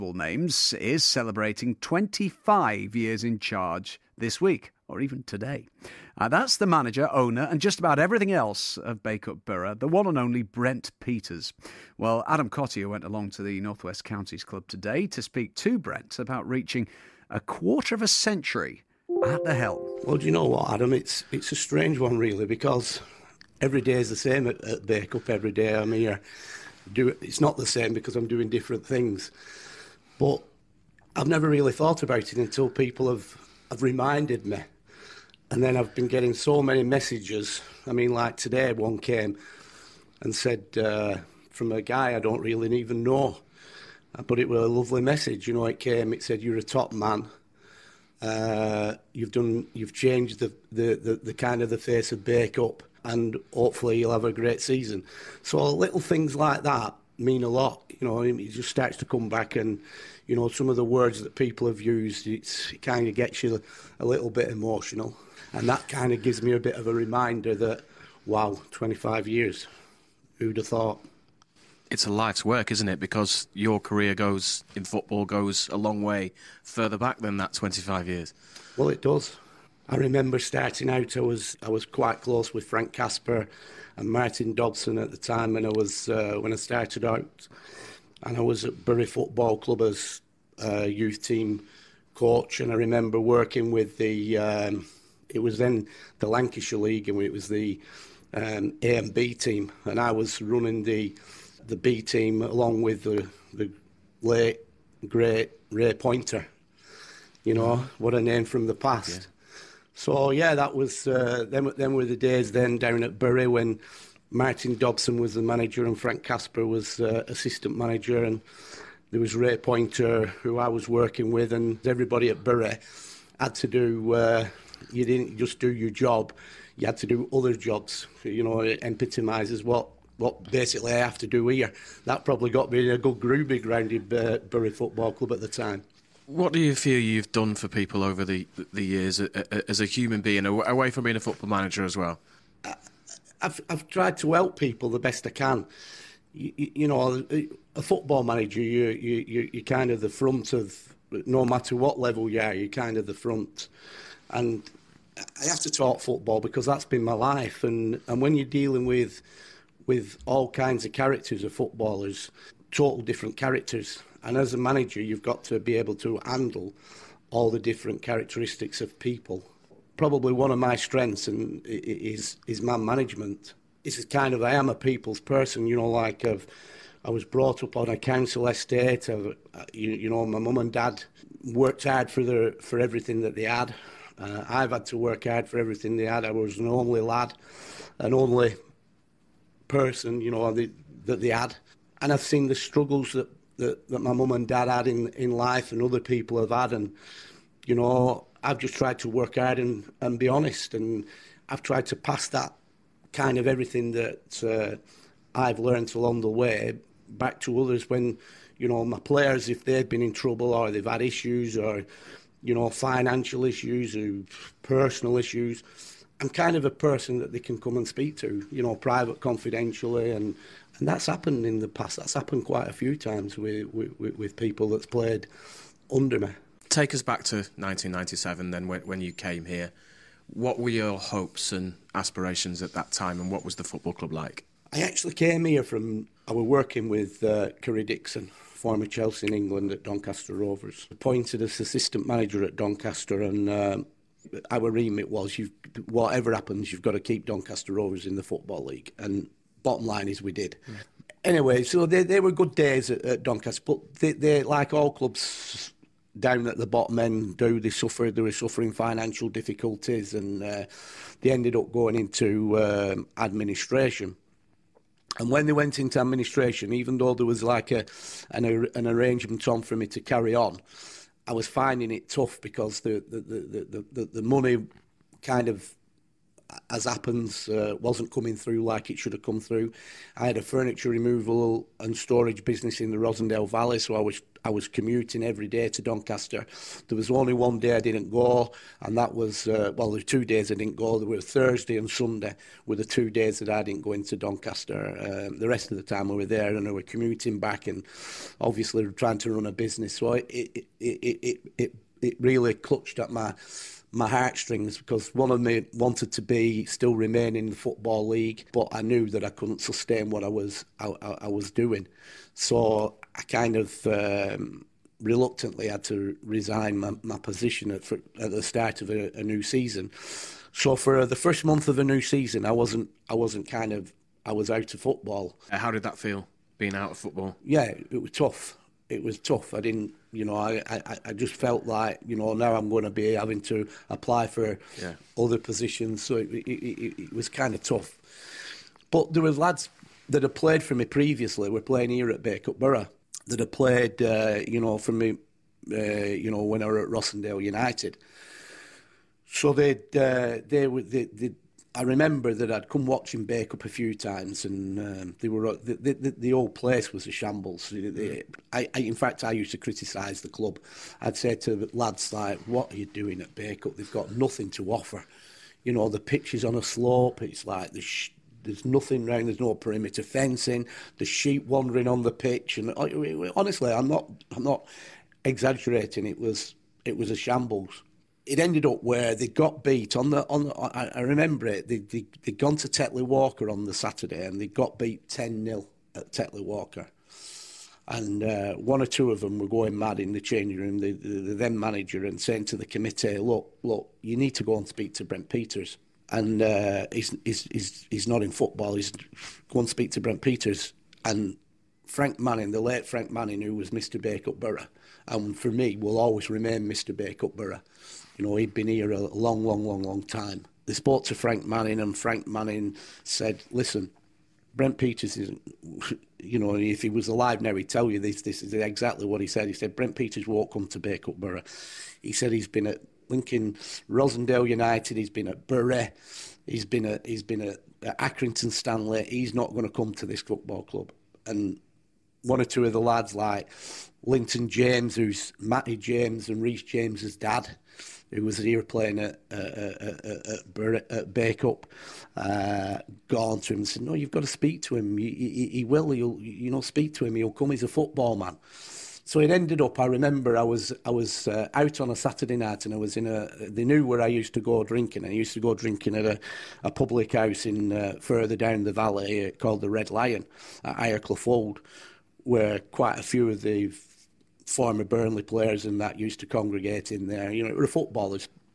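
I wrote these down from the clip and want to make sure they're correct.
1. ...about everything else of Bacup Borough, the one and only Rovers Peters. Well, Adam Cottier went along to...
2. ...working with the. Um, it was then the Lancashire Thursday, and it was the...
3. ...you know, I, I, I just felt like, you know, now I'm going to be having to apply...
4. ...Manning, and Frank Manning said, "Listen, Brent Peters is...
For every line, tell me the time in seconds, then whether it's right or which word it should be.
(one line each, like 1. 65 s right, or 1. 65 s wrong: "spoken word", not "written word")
1. 7 s wrong: "Brent", not "Rovers"
2. 93 s wrong: "League", not "Thursday"
3. 330 s right
4. 411 s right.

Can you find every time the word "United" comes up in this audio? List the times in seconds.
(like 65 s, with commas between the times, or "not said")
347 s, 424 s.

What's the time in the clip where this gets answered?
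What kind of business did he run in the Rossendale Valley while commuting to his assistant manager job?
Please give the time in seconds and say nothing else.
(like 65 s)
280 s.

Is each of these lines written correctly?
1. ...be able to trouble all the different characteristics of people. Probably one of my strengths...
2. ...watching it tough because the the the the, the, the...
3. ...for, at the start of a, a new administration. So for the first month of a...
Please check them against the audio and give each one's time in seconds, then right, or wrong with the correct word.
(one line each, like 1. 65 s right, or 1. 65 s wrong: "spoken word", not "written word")
1. 165 s wrong: "handle", not "trouble"
2. 271 s wrong: "finding", not "watching"
3. 317 s wrong: "season", not "administration".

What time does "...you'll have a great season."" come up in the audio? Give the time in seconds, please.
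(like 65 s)
53 s.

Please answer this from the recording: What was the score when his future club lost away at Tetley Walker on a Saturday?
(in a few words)
10-0.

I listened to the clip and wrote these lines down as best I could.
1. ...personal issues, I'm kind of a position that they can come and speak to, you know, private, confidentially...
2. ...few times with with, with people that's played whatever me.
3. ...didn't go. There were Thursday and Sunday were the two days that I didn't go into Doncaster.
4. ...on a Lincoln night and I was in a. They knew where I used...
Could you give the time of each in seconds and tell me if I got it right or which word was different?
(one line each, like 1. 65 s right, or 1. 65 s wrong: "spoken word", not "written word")
1. 214 s wrong: "person", not "position"
2. 222 s wrong: "under", not "whatever"
3. 290 s right
4. 451 s wrong: "Saturday", not "Lincoln".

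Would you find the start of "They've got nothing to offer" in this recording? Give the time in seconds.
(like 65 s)
363 s.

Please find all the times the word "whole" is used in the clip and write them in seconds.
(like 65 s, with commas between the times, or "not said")
356 s.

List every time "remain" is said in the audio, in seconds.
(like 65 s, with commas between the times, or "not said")
306 s, 406 s.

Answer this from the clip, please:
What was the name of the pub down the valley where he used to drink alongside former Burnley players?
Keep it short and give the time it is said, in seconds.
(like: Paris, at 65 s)
Red Lion, at 459 s.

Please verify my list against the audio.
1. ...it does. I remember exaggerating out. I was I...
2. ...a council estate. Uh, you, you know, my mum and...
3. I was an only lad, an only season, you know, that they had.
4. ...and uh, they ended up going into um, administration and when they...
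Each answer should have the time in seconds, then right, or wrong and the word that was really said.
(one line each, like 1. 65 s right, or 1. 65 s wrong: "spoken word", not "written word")
1. 78 s wrong: "starting", not "exaggerating"
2. 177 s right
3. 186 s wrong: "person", not "season"
4. 260 s right.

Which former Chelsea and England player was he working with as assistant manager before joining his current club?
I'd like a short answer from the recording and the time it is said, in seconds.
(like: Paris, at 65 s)
Kerry Dixon, at 237 s.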